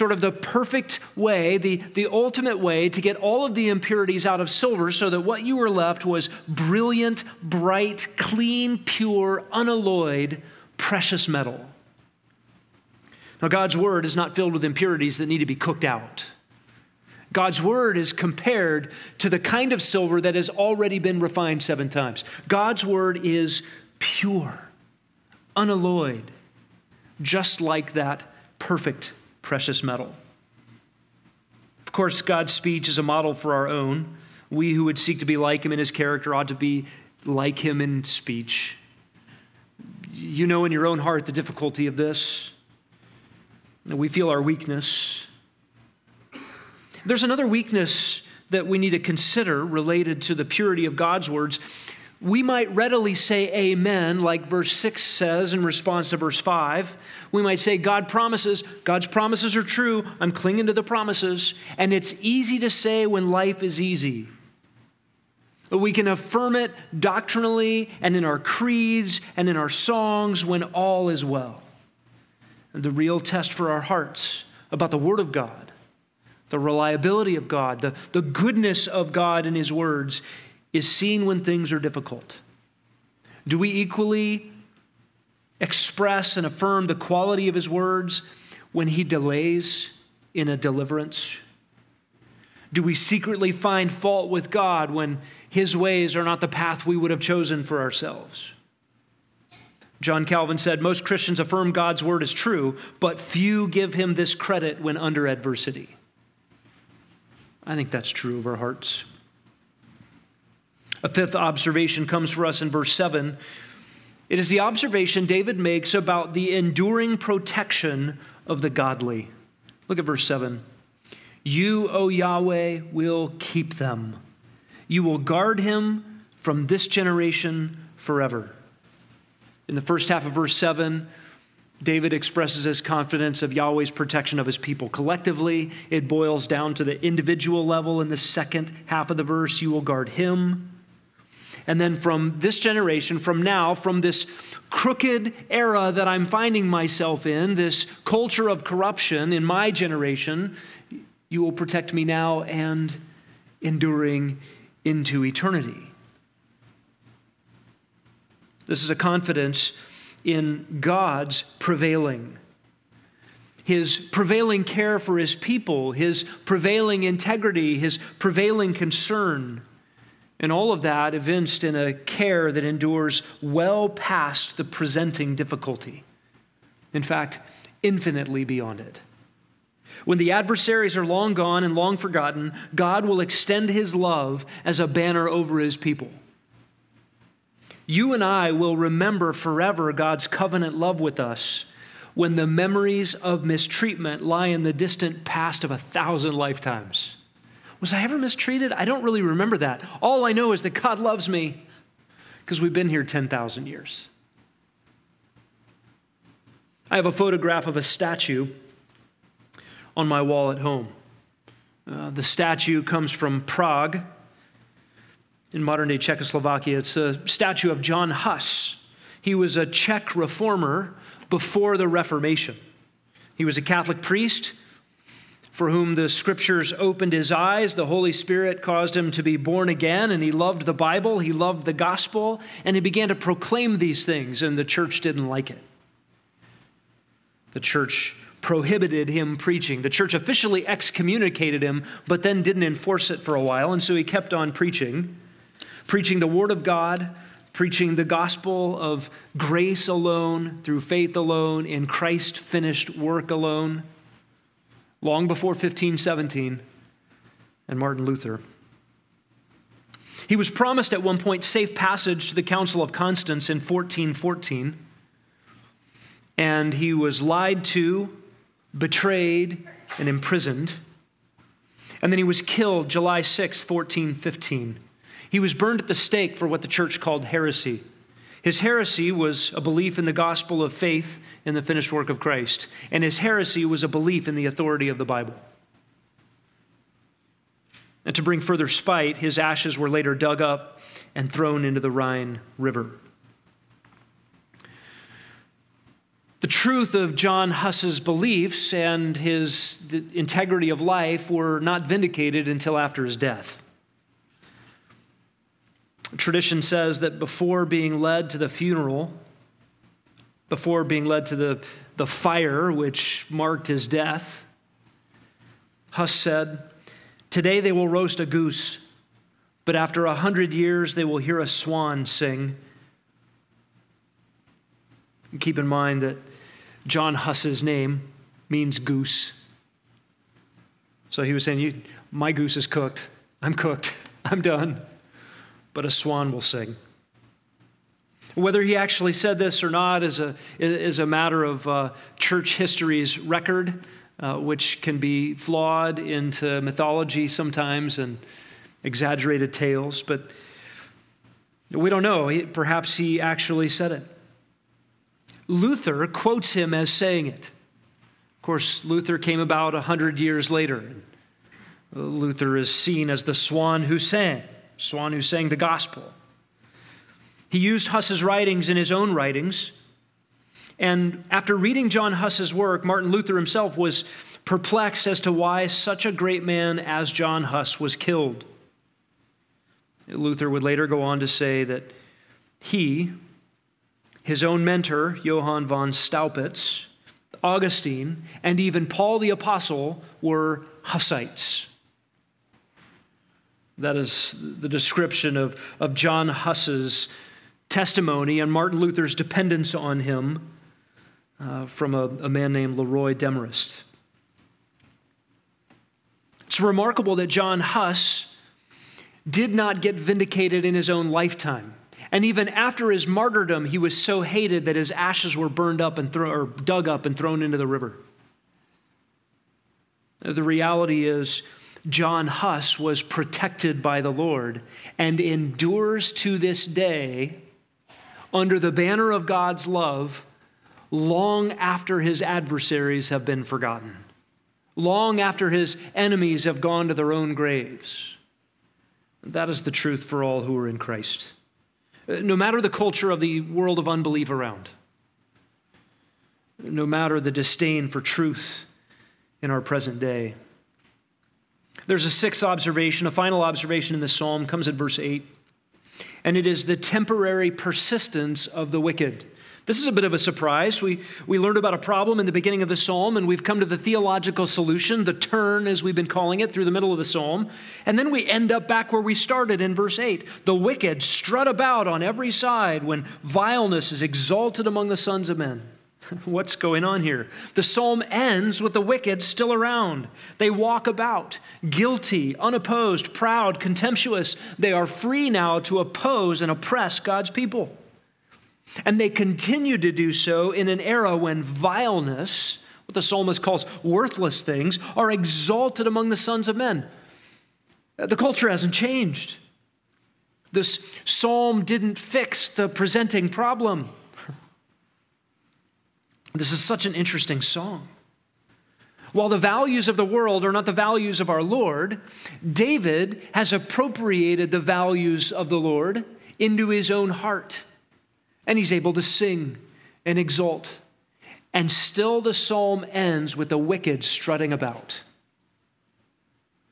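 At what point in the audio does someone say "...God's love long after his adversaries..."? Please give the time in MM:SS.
07:09.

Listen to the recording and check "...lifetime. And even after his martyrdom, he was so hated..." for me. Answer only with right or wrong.
right.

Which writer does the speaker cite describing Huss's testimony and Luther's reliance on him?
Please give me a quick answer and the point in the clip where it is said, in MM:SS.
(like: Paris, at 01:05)
Leroy Demarest, at 06:42.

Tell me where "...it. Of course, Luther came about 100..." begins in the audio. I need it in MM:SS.
05:57.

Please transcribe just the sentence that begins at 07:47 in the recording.
And then we end up back where we started in verse 8.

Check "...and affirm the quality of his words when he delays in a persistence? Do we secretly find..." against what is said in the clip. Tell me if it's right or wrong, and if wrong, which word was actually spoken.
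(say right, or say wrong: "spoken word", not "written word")
wrong: "deliverance", not "persistence".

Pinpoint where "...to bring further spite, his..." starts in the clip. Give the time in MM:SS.
04:48.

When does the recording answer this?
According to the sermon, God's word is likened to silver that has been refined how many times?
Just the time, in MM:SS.
00:21.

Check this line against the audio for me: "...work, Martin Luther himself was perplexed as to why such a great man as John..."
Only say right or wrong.
right.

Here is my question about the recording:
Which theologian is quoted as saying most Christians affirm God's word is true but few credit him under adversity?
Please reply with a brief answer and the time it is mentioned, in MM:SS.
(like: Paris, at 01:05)
John Calvin, at 01:40.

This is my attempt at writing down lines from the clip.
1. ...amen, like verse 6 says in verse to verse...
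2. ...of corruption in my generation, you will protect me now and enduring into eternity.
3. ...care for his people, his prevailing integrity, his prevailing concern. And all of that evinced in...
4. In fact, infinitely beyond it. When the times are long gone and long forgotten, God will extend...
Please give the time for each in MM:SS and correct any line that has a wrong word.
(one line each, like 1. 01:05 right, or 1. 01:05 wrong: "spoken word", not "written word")
1. 00:53 wrong: "response", not "verse"
2. 02:28 right
3. 02:44 right
4. 02:56 wrong: "adversaries", not "times".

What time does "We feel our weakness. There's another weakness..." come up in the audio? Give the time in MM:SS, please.
00:43.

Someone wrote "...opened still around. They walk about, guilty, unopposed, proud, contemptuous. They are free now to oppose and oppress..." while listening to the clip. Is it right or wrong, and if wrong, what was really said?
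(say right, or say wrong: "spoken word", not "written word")
wrong: "wicked", not "opened".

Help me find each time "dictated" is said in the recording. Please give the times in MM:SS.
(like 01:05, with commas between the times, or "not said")
not said.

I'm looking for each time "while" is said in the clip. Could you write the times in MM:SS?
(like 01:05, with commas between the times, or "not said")
04:03, 08:29.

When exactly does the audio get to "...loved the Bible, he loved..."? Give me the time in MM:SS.
03:50.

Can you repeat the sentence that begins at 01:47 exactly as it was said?
I think that's true of our hearts.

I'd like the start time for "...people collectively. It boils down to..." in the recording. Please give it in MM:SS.
02:14.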